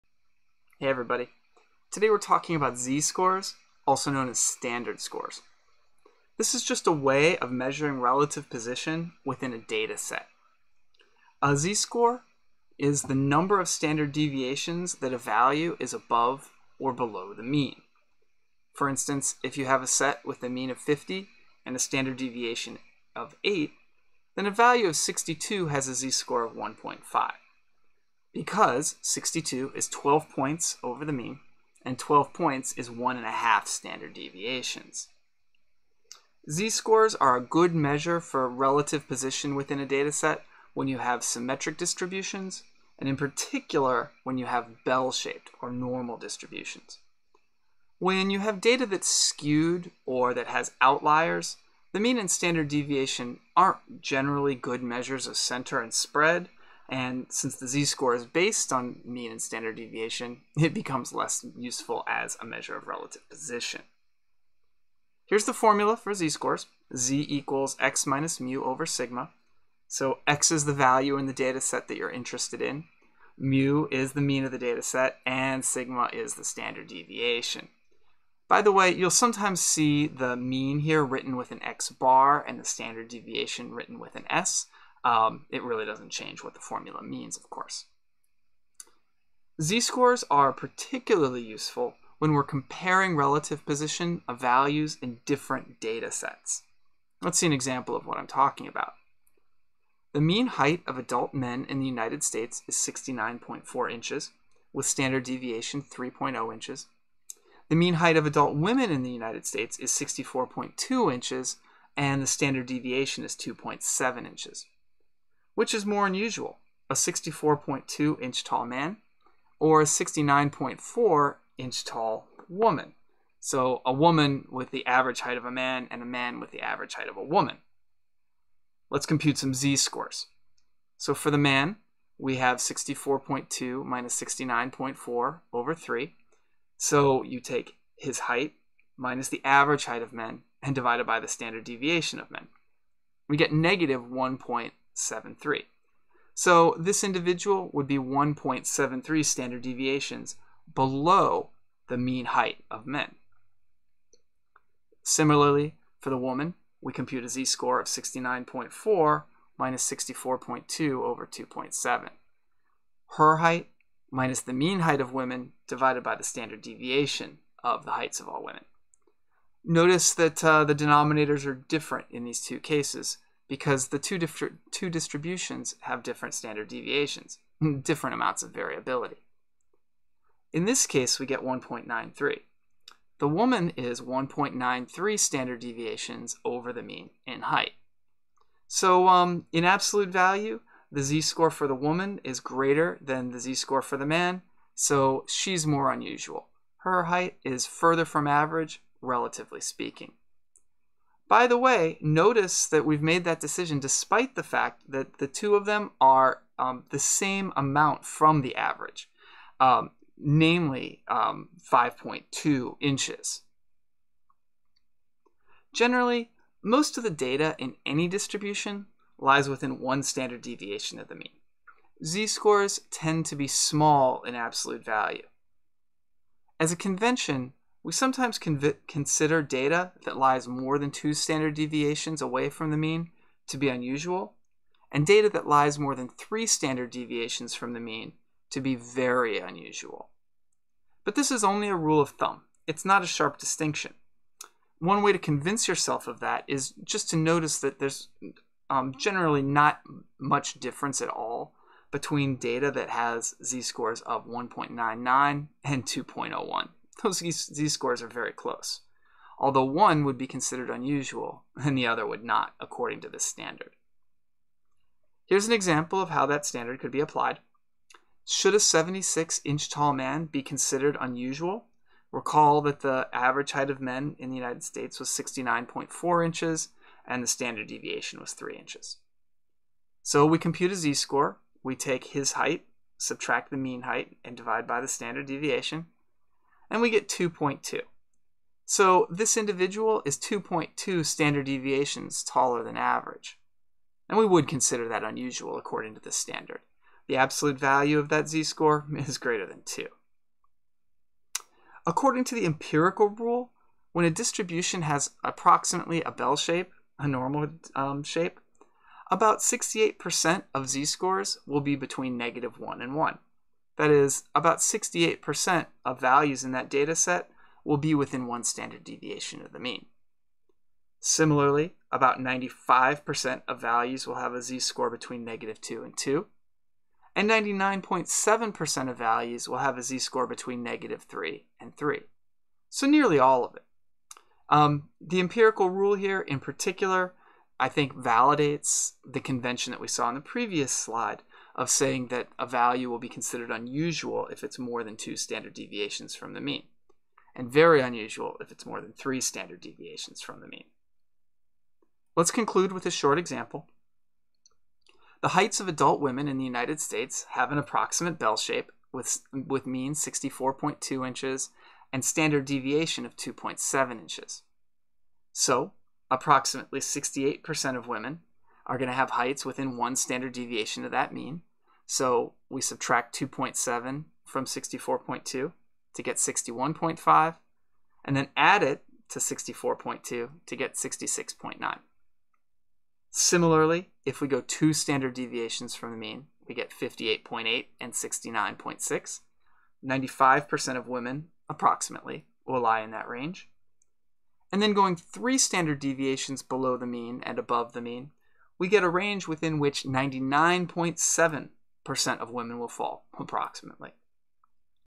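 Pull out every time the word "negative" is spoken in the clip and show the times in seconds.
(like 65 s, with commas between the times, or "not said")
143 s, 312 s, 325 s, 330 s.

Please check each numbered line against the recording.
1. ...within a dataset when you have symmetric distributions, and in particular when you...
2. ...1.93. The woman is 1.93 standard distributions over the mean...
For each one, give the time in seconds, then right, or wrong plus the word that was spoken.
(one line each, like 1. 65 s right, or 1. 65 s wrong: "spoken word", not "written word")
1. 39 s right
2. 181 s wrong: "deviations", not "distributions".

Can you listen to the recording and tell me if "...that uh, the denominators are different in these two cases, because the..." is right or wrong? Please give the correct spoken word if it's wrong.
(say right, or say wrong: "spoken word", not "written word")
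right.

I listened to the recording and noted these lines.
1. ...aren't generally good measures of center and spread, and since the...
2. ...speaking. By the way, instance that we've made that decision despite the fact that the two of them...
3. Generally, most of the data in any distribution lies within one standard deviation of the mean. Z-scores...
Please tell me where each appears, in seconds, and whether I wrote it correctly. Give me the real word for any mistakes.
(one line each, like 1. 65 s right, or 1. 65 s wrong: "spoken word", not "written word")
1. 53 s right
2. 199 s wrong: "notice", not "instance"
3. 215 s right.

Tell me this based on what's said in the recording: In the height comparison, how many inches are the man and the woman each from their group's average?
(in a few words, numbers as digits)
5.2 inches.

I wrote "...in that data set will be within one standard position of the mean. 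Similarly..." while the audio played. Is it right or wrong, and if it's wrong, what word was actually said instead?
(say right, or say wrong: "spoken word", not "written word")
wrong: "deviation", not "position".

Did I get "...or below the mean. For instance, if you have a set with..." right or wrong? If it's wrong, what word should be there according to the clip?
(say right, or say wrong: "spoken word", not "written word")
right.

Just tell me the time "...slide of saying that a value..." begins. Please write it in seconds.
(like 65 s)
340 s.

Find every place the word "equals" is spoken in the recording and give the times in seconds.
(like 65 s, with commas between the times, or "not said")
67 s.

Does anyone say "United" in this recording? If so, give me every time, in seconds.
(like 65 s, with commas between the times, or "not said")
101 s, 109 s, 274 s, 356 s.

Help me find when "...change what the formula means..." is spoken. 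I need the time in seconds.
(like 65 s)
86 s.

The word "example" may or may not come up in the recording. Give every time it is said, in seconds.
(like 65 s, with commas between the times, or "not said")
97 s, 265 s, 353 s.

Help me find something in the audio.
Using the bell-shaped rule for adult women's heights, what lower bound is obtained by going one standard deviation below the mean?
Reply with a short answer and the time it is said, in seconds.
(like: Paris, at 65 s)
61.5, at 376 s.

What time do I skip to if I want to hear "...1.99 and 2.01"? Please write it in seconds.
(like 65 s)
254 s.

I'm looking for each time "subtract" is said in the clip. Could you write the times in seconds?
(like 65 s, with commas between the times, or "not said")
282 s, 372 s.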